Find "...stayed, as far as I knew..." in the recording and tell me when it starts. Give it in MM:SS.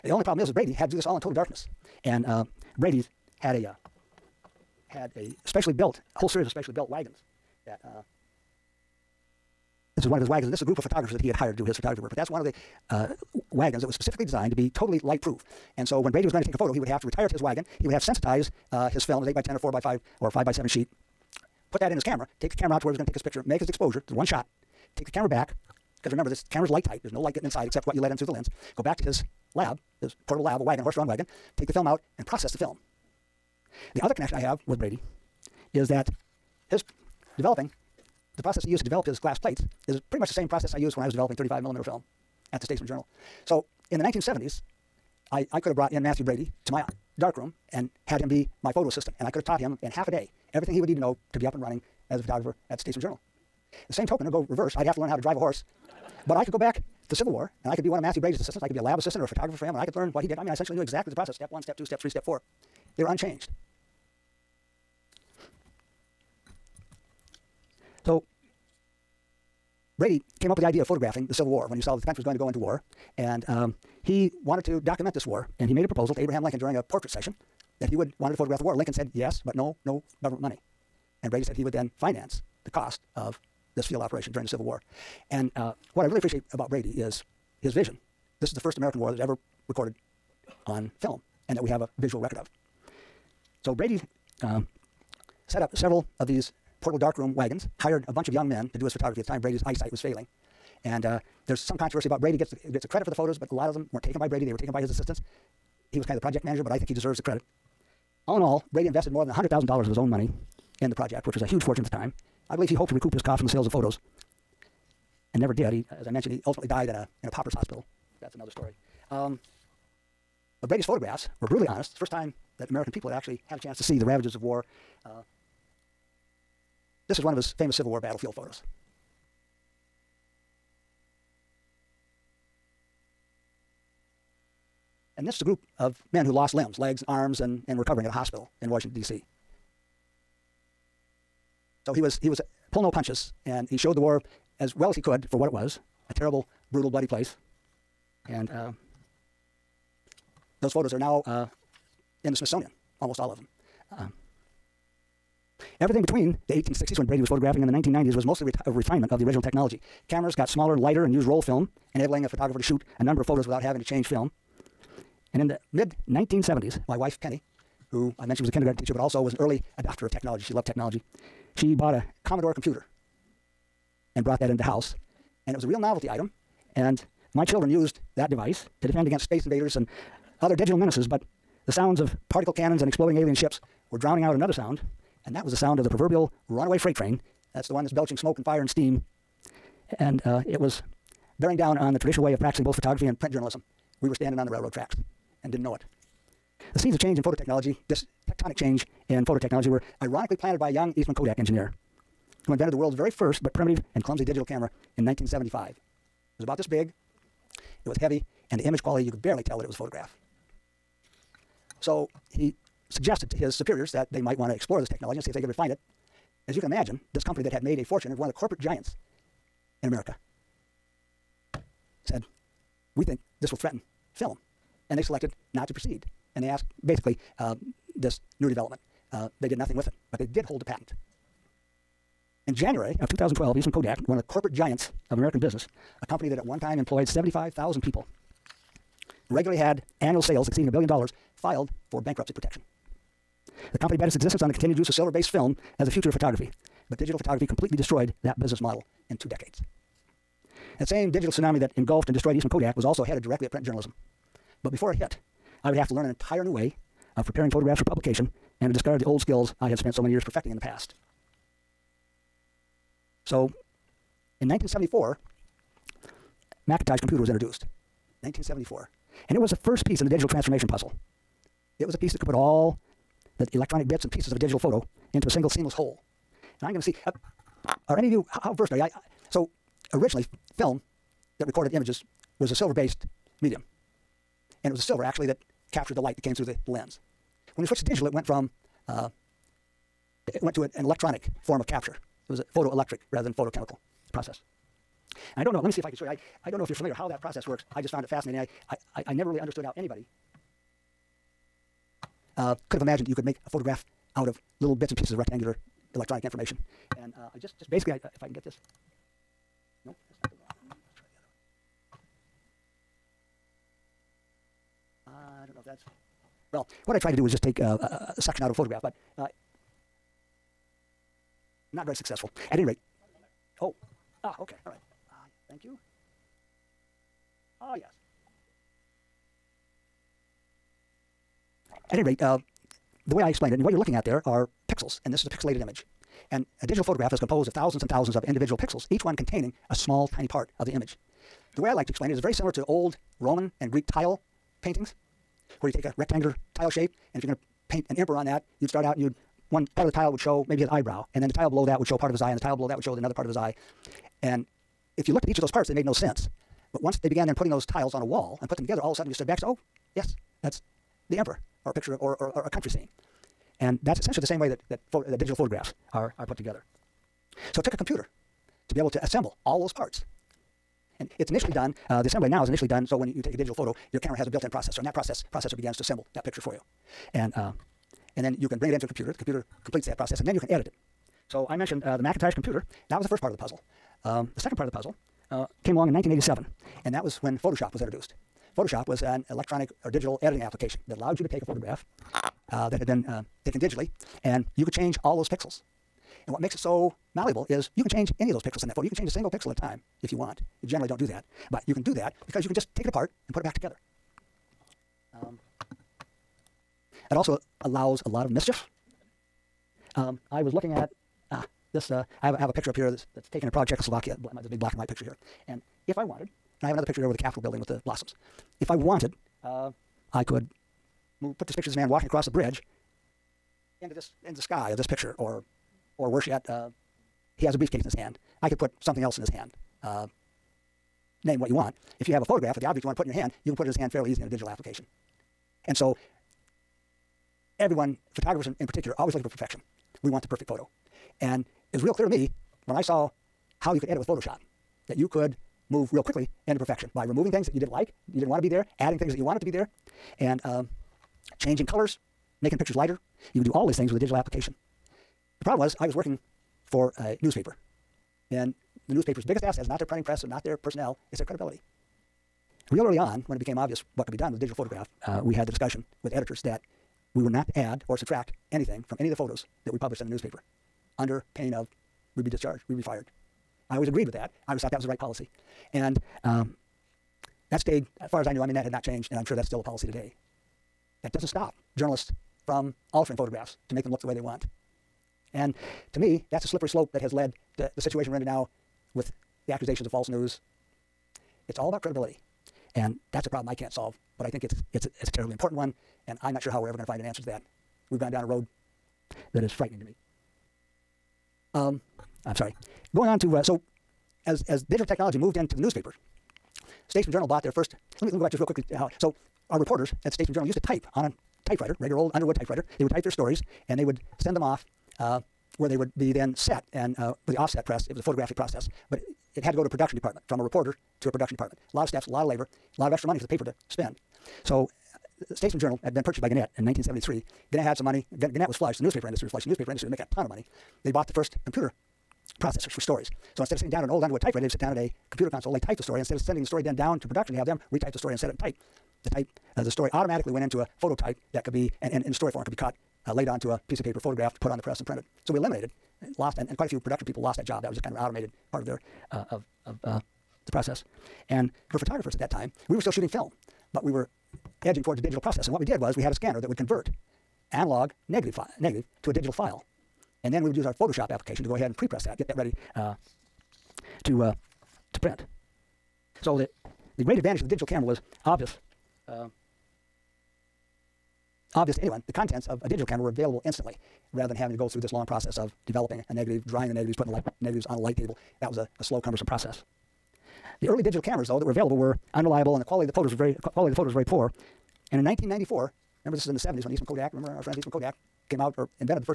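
07:57.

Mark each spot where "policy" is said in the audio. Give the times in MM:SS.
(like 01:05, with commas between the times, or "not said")
07:54, 07:59.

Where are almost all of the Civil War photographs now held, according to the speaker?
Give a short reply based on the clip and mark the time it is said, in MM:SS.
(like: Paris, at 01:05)
the Smithsonian, at 02:32.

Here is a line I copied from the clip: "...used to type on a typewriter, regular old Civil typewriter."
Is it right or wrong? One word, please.
wrong.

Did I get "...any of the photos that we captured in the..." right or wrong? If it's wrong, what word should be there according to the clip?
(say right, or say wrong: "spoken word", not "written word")
wrong: "published", not "captured".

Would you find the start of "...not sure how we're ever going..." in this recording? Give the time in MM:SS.
08:16.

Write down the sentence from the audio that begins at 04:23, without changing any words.
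So in 1974, Macintosh computer was introduced.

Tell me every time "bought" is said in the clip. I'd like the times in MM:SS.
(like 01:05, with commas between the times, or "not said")
02:51, 08:27, 08:50.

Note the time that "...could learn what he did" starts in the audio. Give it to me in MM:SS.
00:59.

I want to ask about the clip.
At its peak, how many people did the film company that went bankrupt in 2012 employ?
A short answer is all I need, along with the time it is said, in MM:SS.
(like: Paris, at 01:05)
75,000, at 03:57.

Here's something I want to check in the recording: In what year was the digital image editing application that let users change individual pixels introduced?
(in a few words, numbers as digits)
1987.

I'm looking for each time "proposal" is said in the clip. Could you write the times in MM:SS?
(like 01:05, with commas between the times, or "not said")
01:15.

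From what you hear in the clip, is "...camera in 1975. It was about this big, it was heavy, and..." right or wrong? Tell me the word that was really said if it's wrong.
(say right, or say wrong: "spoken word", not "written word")
right.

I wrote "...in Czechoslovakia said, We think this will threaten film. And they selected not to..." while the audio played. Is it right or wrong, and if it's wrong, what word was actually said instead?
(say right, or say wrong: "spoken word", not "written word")
wrong: "America", not "Czechoslovakia".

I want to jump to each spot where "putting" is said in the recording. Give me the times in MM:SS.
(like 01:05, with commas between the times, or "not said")
05:57, 09:36.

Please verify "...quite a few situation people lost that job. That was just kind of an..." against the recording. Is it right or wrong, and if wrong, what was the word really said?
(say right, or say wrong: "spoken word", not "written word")
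wrong: "production", not "situation".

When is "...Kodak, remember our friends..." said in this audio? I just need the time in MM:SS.
09:46.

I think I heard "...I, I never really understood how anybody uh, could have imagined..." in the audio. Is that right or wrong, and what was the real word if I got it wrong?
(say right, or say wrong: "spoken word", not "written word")
right.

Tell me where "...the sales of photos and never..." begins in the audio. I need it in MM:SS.
01:53.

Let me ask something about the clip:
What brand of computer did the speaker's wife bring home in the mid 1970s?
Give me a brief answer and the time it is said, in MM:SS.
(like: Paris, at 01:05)
Commodore, at 02:52.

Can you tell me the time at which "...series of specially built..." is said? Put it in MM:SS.
00:06.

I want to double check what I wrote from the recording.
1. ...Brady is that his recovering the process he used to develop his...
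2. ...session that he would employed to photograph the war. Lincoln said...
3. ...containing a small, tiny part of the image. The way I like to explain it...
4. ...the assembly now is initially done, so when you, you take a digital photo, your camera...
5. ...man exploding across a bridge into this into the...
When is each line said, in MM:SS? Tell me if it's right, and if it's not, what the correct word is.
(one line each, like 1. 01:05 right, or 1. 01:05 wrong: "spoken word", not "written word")
1. 00:34 wrong: "developing", not "recovering"
2. 01:17 wrong: "wanted", not "employed"
3. 05:39 right
4. 06:12 right
5. 07:01 wrong: "walking", not "exploding".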